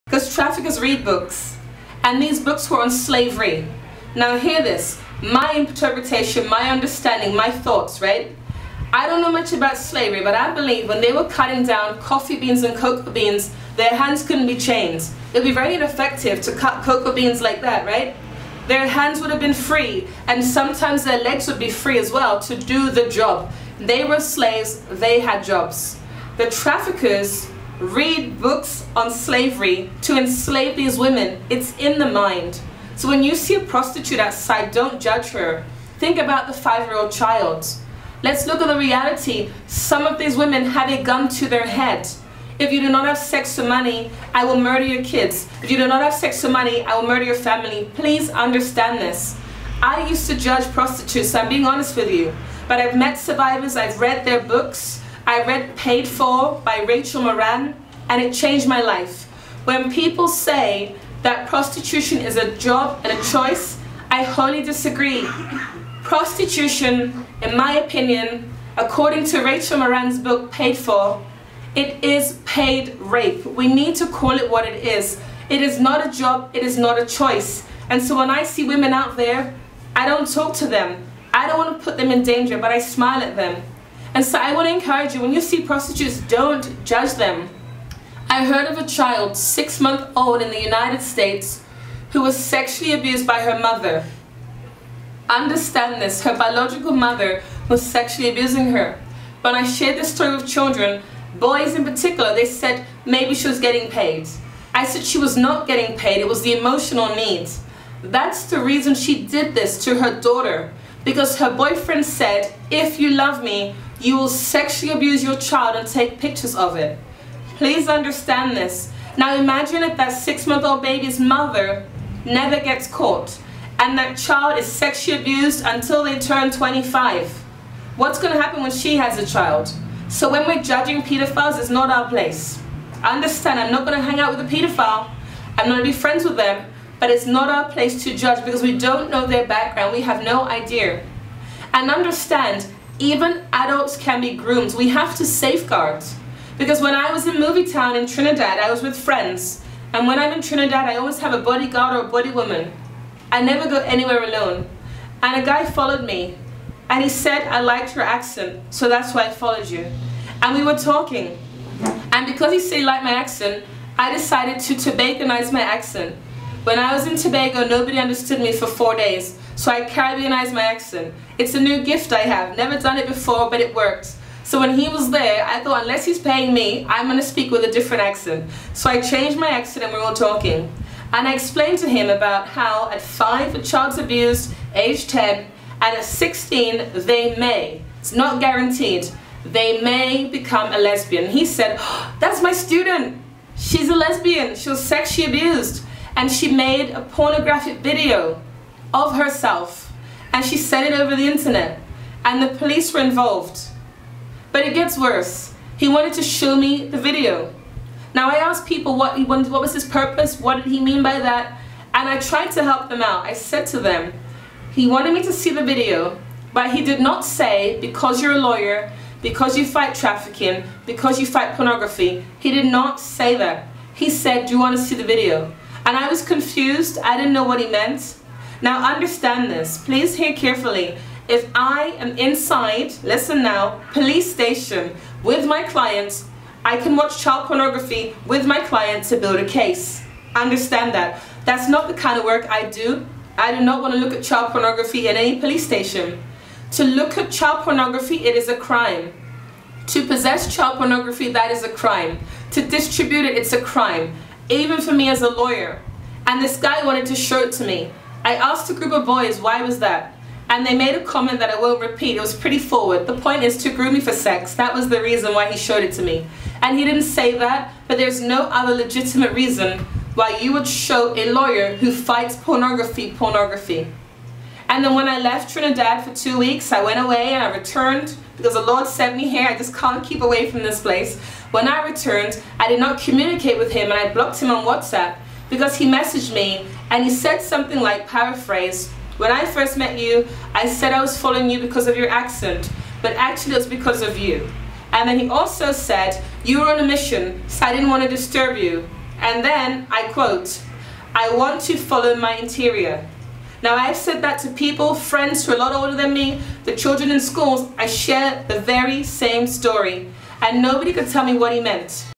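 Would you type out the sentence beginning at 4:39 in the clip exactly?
I just can't keep away from this place.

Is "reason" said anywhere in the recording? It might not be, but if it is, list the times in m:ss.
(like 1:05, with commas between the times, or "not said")
1:48, 4:25, 4:29.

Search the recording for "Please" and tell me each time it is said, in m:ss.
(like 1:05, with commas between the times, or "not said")
0:47, 1:57, 3:49.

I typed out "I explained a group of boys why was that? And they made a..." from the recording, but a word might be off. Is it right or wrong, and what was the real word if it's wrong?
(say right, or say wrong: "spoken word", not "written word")
wrong: "asked", not "explained".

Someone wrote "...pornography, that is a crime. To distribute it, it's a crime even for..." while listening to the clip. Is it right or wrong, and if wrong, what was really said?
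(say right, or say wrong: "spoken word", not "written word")
right.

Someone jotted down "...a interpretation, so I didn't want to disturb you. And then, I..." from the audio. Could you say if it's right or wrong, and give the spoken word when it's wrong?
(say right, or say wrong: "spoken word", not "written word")
wrong: "mission", not "interpretation".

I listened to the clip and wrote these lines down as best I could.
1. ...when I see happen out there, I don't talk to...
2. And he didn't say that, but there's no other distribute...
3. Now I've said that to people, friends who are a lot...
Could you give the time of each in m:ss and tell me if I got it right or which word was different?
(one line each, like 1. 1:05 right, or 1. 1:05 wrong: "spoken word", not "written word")
1. 1:18 wrong: "women", not "happen"
2. 4:26 wrong: "legitimate", not "distribute"
3. 5:03 right.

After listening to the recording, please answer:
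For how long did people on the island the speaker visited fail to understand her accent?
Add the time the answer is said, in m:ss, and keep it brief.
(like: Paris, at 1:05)
4 days, at 2:48.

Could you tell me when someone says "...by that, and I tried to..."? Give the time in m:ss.
3:31.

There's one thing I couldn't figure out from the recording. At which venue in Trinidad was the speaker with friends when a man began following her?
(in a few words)
MovieTowne.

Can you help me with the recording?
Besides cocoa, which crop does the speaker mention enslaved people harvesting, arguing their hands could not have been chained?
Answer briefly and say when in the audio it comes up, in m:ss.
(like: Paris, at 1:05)
coffee, at 0:11.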